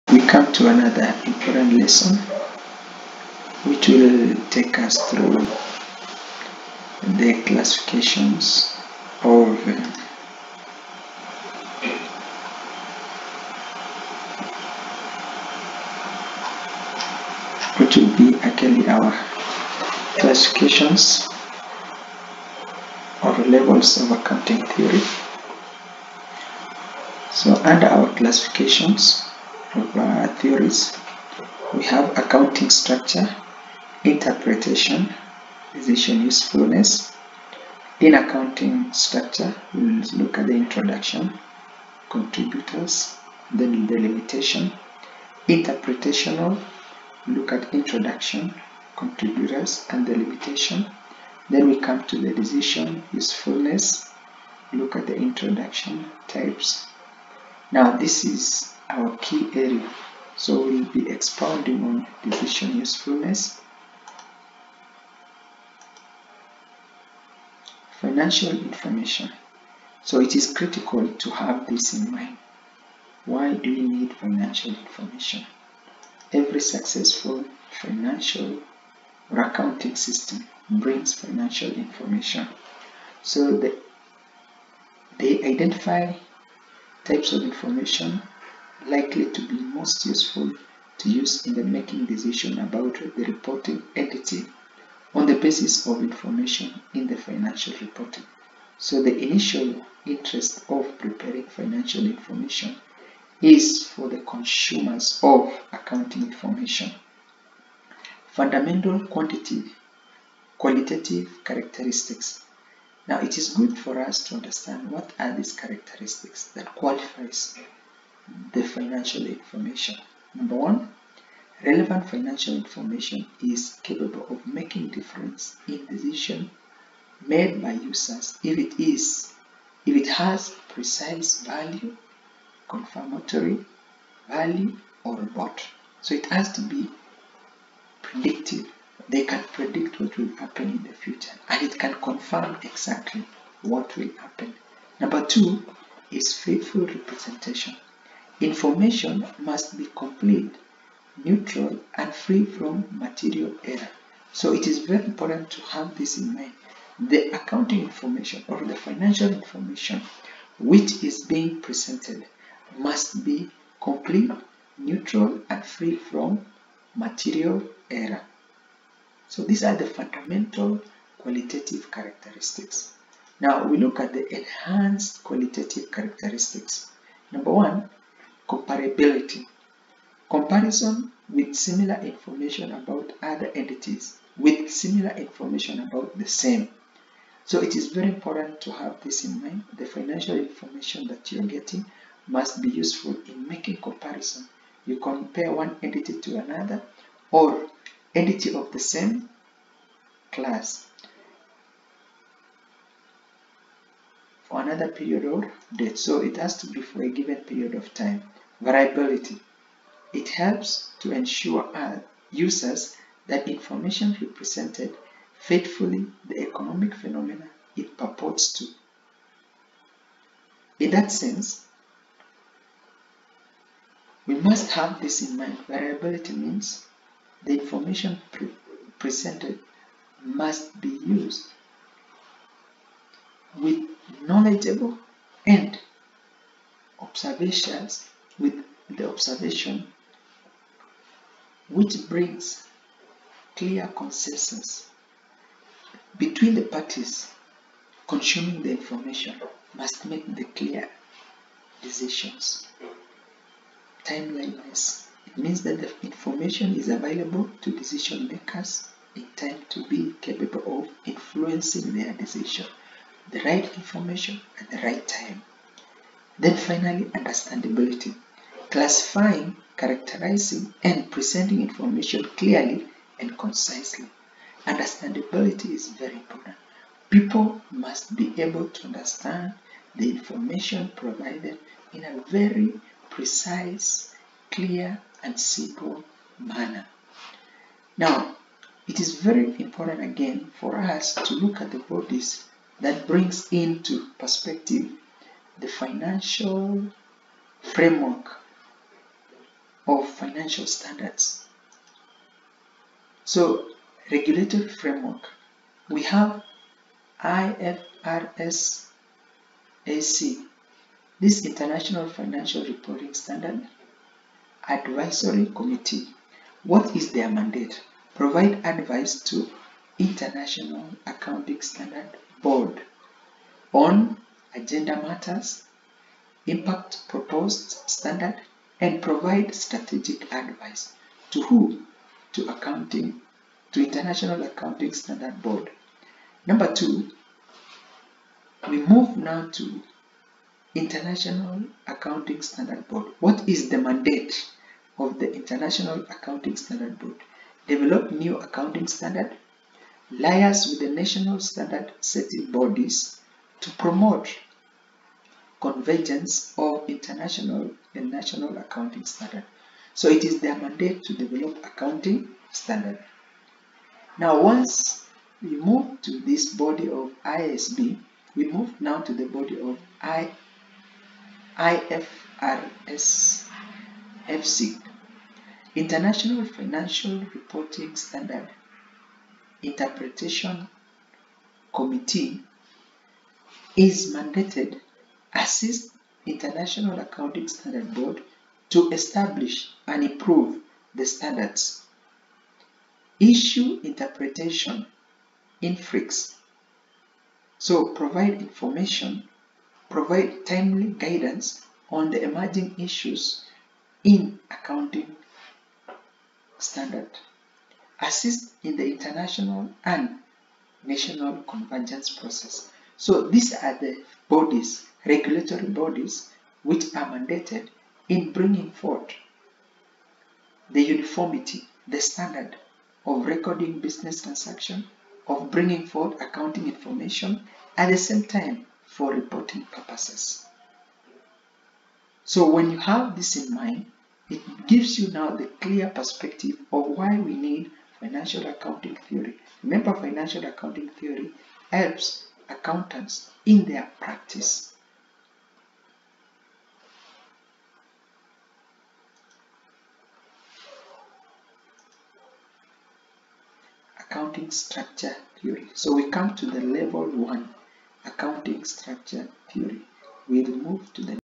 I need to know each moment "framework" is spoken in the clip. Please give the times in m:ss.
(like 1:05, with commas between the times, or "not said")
4:57, 5:04.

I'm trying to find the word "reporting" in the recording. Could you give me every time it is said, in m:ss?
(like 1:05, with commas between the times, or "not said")
1:33, 1:37, 5:12, 6:17, 7:09.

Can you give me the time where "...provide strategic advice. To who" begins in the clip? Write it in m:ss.
5:29.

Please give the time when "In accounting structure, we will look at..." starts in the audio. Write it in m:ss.
0:37.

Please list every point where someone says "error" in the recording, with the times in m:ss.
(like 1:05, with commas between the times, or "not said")
2:33, 2:47.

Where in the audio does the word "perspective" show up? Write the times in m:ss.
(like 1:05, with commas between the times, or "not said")
4:54, 7:15.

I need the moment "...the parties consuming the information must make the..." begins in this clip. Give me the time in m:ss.
4:06.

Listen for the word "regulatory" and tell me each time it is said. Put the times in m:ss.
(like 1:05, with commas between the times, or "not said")
5:04, 6:55.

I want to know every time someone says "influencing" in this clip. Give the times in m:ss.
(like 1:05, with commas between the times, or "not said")
4:21.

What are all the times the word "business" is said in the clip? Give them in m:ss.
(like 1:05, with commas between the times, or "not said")
7:03.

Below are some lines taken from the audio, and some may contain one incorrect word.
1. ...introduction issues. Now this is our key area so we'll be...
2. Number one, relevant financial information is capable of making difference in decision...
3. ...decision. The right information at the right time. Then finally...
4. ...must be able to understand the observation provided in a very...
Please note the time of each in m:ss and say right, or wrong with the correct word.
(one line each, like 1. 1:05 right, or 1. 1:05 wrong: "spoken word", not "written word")
1. 0:55 wrong: "types", not "issues"
2. 2:00 right
3. 4:22 right
4. 4:37 wrong: "information", not "observation".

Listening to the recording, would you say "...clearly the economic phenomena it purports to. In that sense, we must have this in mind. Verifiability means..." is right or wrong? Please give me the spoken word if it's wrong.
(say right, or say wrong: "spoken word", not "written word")
wrong: "faithfully", not "clearly".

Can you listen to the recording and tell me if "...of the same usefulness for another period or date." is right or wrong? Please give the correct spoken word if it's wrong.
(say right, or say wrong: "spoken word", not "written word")
wrong: "class", not "usefulness".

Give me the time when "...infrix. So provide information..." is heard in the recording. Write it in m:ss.
6:35.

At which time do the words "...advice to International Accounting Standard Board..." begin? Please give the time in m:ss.
5:18.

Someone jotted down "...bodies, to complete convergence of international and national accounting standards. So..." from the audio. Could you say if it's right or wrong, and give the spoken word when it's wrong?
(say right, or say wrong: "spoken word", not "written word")
wrong: "promote", not "complete".